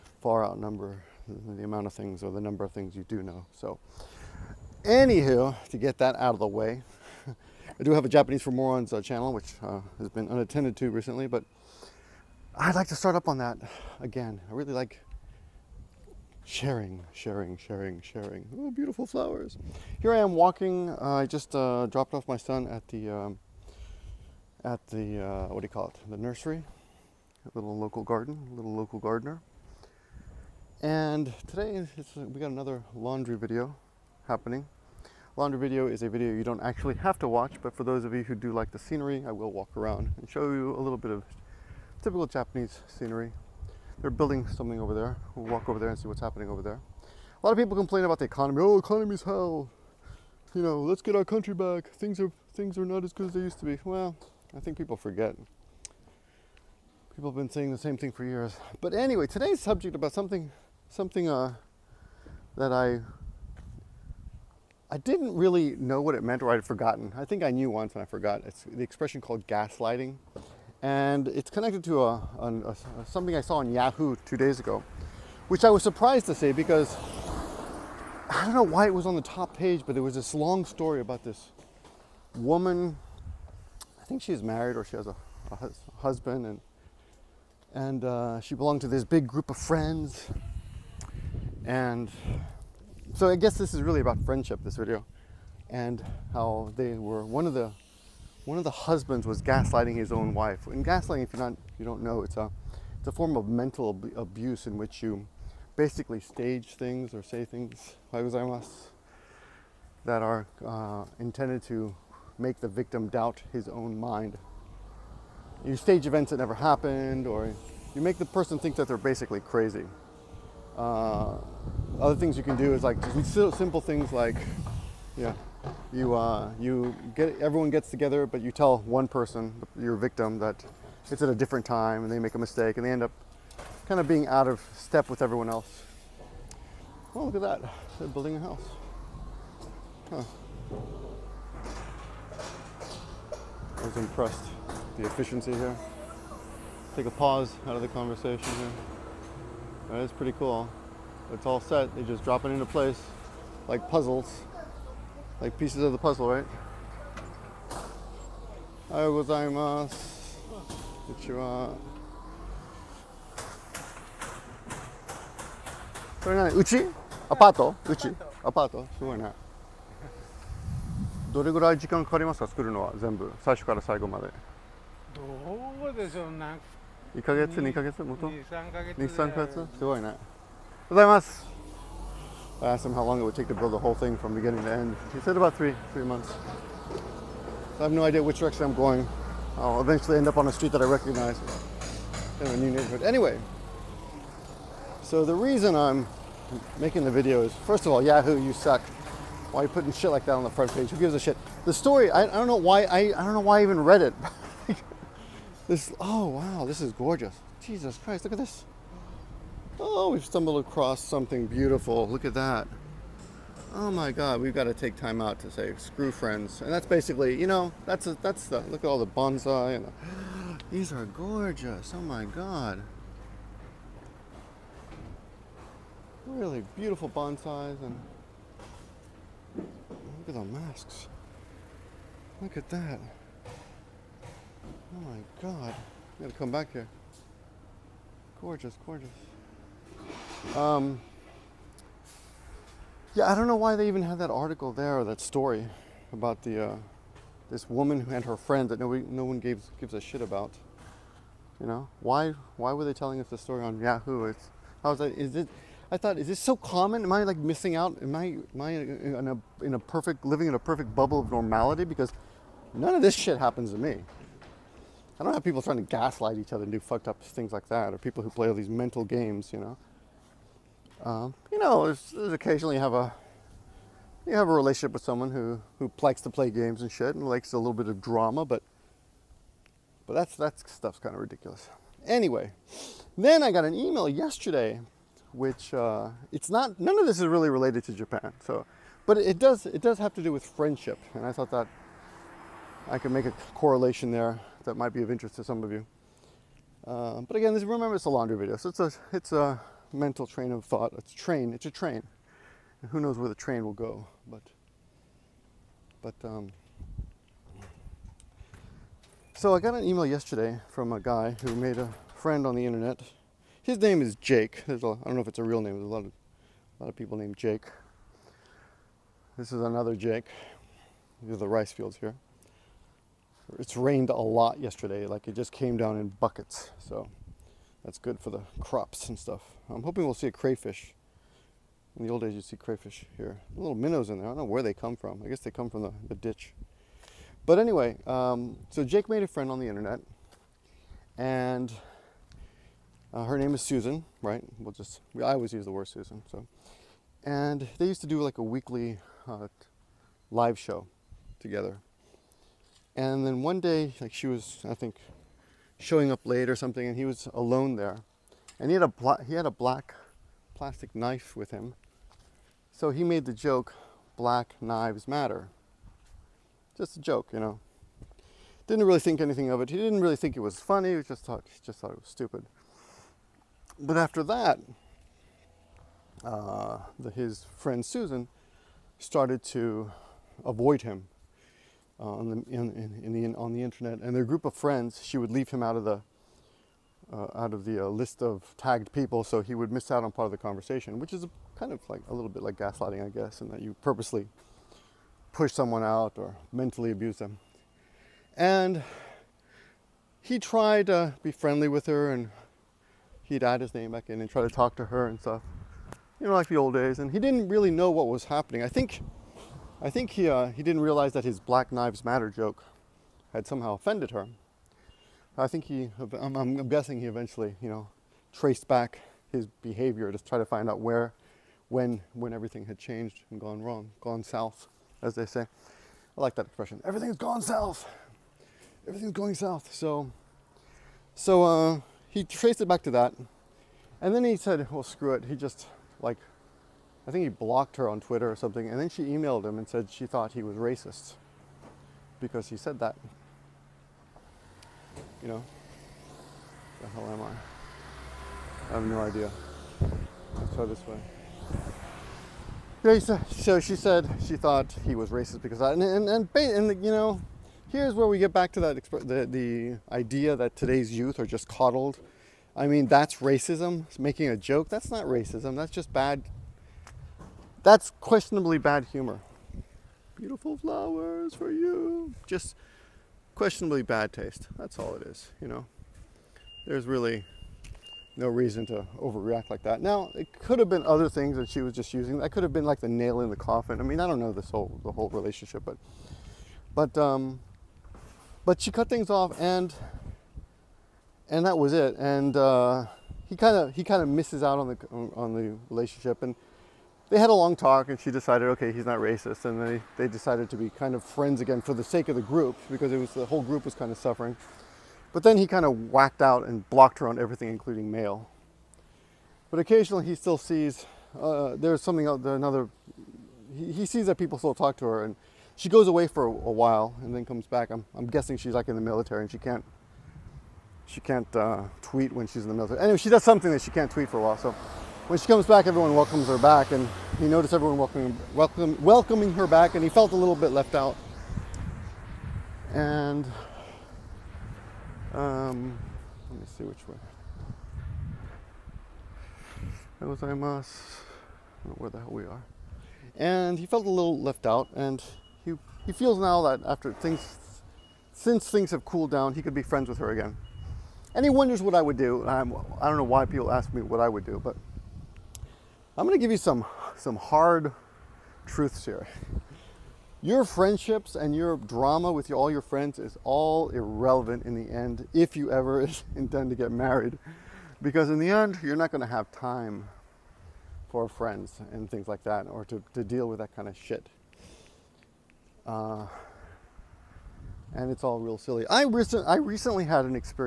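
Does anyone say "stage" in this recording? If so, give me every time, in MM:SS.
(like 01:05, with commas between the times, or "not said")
01:46, 01:55.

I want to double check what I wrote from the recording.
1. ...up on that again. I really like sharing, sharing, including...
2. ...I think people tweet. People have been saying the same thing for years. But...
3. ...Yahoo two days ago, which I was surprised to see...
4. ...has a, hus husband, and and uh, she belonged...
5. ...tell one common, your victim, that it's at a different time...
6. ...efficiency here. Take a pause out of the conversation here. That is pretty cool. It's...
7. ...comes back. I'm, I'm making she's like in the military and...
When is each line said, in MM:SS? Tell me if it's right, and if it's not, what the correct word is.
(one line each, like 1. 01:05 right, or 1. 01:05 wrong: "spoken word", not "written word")
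1. 00:13 wrong: "sharing", not "including"
2. 00:54 wrong: "forget", not "tweet"
3. 01:13 right
4. 01:24 right
5. 02:08 wrong: "person", not "common"
6. 02:25 right
7. 08:37 wrong: "guessing", not "making".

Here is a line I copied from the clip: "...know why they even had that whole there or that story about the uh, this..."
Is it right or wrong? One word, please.
wrong.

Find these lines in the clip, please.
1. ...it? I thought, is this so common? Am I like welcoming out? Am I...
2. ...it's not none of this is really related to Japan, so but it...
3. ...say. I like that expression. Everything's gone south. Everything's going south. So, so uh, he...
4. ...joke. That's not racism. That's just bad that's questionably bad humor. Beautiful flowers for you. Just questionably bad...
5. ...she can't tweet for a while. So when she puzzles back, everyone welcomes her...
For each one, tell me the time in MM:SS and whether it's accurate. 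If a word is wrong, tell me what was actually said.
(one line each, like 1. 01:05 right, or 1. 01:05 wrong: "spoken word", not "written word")
1. 04:15 wrong: "missing", not "welcoming"
2. 04:46 right
3. 07:05 right
4. 07:44 right
5. 08:43 wrong: "comes", not "puzzles".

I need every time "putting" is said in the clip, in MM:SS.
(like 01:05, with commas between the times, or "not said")
03:19.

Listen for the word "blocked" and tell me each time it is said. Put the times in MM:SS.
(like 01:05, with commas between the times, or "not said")
07:17, 08:26.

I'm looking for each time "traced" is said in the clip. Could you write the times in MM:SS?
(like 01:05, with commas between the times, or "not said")
06:58, 07:12.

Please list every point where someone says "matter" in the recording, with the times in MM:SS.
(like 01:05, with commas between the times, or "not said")
06:05, 06:52.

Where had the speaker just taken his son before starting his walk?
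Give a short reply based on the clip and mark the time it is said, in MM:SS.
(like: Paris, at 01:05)
the nursery, at 00:26.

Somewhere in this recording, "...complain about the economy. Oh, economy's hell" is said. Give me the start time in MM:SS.
00:47.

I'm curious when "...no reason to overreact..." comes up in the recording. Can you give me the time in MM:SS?
07:58.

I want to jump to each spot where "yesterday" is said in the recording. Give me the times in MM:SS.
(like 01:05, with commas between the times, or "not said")
04:44, 05:10, 05:24.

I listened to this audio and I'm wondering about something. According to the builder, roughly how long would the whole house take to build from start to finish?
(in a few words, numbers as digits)
3 months.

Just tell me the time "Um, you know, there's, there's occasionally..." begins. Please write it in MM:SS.
04:31.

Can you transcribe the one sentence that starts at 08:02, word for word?
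That could have been like the nail in the coffin.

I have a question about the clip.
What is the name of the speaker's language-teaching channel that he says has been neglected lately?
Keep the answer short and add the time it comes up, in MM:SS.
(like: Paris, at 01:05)
Japanese for Morons, at 00:08.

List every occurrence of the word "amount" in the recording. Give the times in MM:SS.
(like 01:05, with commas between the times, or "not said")
00:01.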